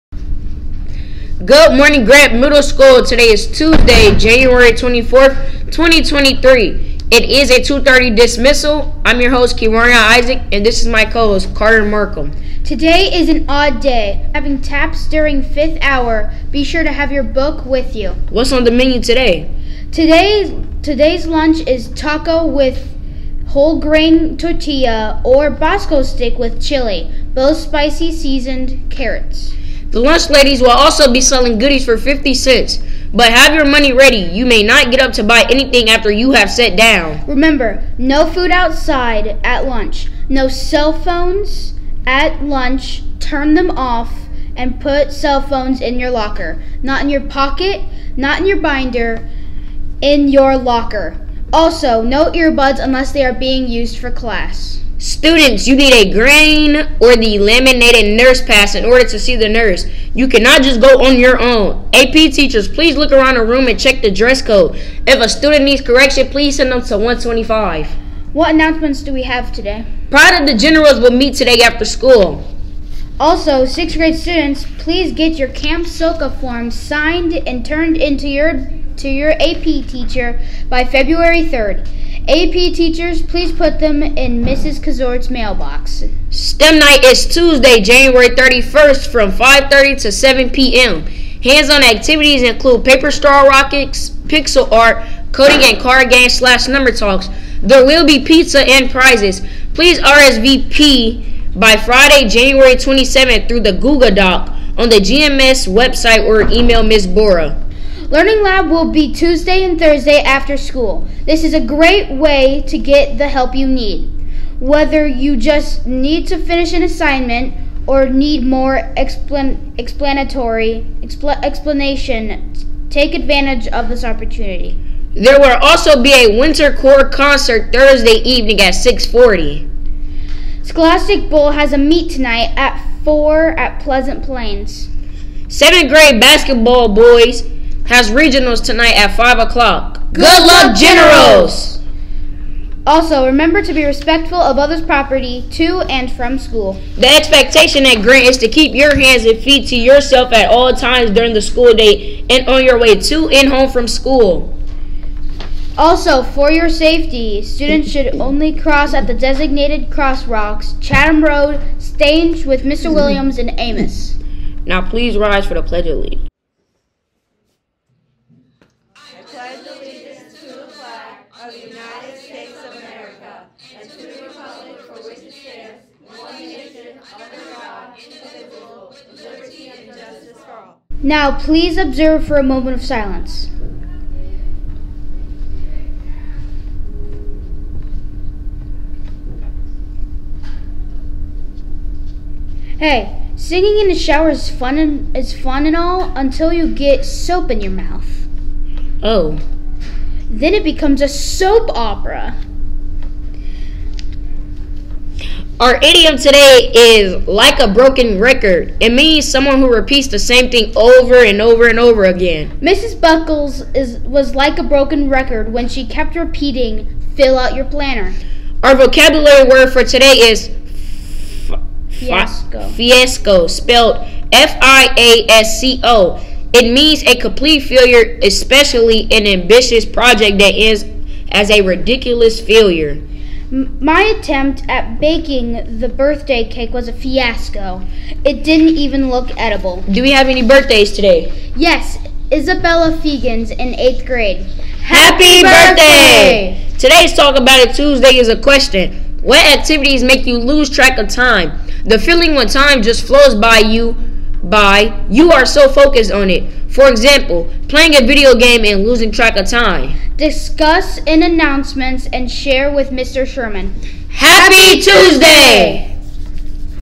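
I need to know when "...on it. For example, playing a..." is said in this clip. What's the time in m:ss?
4:16.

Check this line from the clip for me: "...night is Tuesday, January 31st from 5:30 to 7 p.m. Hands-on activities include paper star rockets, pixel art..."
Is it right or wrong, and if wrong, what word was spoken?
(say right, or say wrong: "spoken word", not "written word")
right.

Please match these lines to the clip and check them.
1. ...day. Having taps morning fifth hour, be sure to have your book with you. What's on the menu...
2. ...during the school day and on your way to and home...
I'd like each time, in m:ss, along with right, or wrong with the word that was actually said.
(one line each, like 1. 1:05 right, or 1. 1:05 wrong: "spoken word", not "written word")
1. 0:13 wrong: "during", not "morning"
2. 2:31 right.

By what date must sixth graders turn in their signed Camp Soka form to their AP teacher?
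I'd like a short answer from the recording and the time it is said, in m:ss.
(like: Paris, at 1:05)
February 3rd, at 1:20.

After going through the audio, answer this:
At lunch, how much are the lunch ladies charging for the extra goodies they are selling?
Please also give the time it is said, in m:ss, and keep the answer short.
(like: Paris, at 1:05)
50 cents, at 0:31.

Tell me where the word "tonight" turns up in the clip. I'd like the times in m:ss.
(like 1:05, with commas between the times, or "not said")
2:12, 2:18.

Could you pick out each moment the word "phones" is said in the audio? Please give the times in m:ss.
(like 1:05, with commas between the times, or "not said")
0:40, 0:45.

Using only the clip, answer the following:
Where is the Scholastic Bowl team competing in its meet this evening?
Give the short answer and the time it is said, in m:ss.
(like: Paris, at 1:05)
Pleasant Plains, at 2:13.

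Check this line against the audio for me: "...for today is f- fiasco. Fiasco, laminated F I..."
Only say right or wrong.
wrong.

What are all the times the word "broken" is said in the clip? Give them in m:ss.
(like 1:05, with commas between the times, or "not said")
3:27, 3:34.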